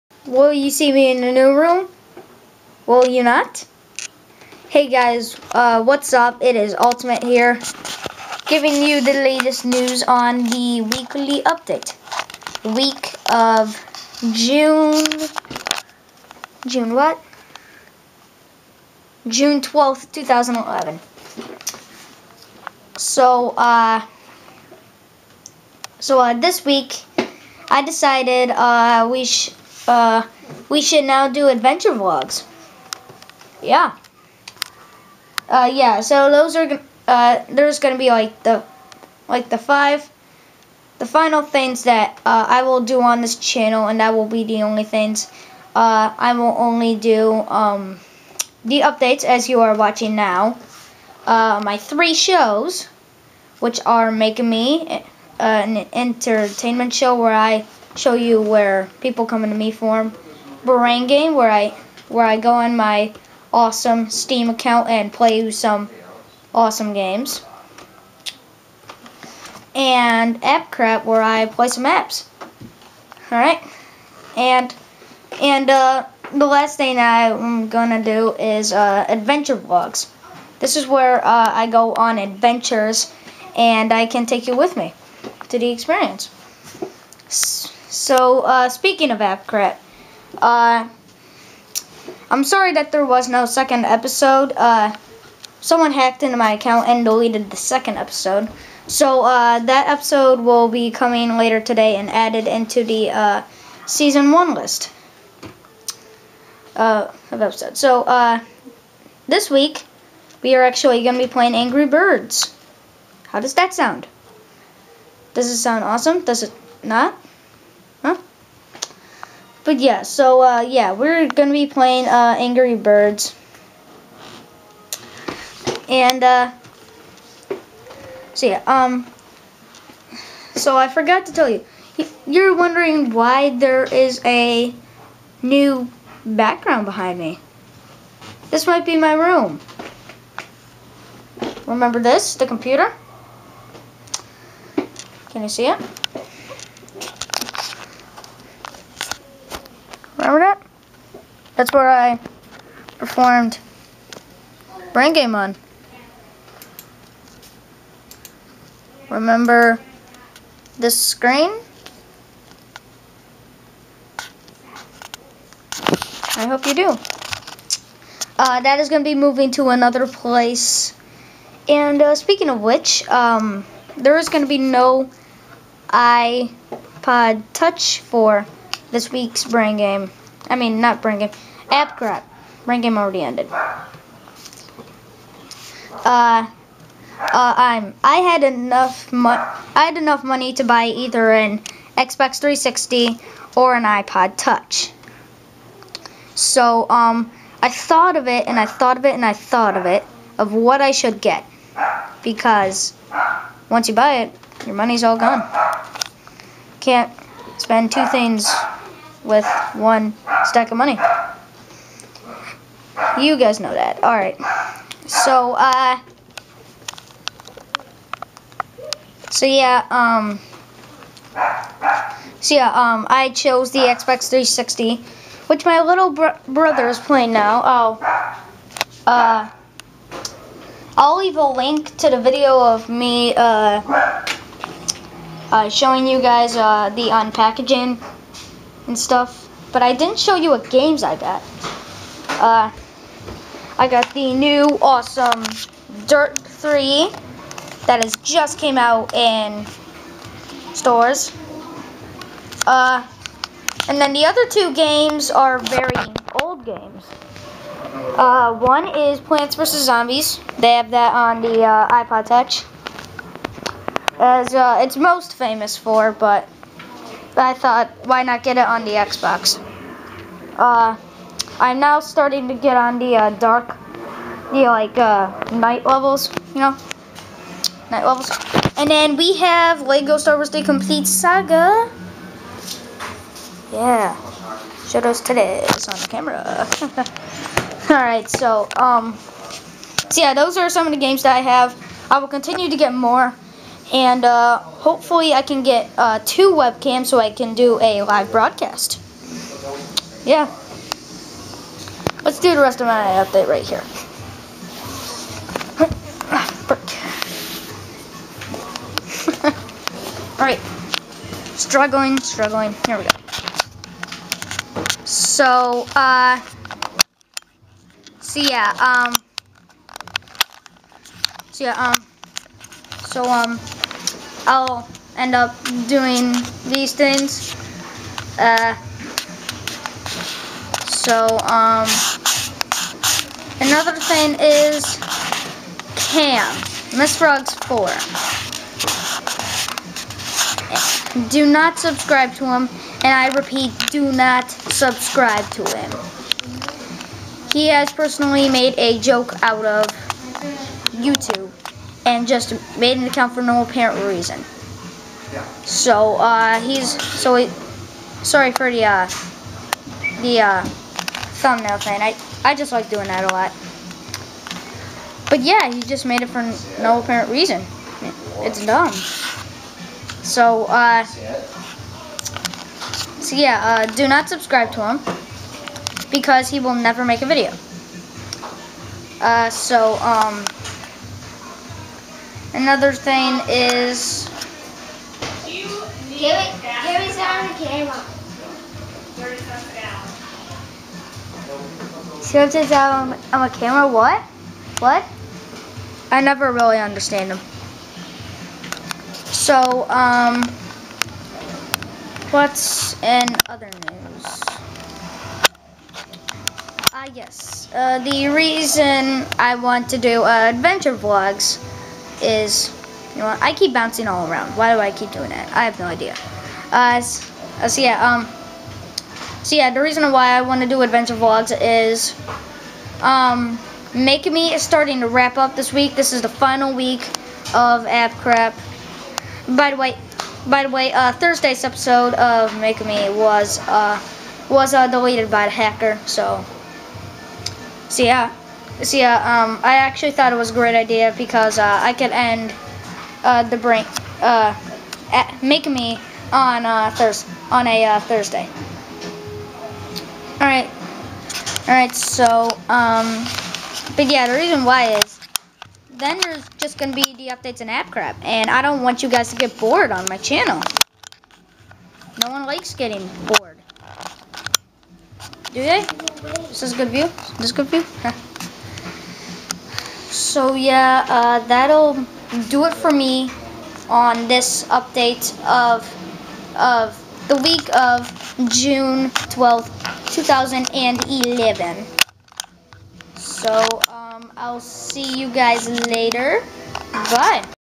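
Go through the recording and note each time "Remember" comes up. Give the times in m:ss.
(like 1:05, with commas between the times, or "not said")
2:21, 2:30, 2:39.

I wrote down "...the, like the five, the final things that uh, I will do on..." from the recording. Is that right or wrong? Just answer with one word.
right.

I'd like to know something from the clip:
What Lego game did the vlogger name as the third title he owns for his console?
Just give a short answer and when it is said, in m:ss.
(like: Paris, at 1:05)
Lego Star Wars: The Complete Saga, at 4:39.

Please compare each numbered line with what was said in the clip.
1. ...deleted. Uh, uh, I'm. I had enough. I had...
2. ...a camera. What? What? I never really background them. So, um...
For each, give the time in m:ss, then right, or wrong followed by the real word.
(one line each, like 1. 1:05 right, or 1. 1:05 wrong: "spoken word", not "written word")
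1. 3:03 wrong: "ended", not "deleted"
2. 6:33 wrong: "understand", not "background".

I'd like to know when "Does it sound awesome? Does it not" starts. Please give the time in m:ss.
1:55.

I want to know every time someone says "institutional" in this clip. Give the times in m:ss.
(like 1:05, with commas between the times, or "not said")
not said.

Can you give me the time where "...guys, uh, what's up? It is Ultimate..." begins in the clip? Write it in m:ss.
0:04.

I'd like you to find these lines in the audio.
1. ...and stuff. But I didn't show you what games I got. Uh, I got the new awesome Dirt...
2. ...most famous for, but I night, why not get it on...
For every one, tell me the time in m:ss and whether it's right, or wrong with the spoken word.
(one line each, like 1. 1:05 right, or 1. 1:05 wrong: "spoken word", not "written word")
1. 3:58 right
2. 4:24 wrong: "thought", not "night".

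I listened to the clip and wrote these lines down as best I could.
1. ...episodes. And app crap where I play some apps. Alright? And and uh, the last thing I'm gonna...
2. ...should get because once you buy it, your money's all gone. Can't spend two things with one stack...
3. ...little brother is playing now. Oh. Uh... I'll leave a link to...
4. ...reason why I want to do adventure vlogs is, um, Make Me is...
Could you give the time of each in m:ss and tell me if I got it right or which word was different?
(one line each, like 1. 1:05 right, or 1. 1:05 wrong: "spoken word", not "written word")
1. 1:06 wrong: "games", not "episodes"
2. 3:20 right
3. 3:45 right
4. 6:59 right.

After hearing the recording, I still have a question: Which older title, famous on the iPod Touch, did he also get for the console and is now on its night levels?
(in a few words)
Plants vs. Zombies.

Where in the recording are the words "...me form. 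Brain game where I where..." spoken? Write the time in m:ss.
0:59.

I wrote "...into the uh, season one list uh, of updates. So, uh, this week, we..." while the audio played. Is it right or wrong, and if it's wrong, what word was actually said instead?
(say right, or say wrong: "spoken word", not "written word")
wrong: "episodes", not "updates".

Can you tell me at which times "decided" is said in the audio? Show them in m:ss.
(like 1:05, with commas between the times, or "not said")
0:27.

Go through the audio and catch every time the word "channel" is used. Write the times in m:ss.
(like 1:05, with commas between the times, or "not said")
0:43, 7:40.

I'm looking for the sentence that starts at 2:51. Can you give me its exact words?
And uh, speaking of which, um, there is going to be no iPod Touch for this week's brain game.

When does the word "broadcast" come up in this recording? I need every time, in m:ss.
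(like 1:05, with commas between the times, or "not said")
4:58.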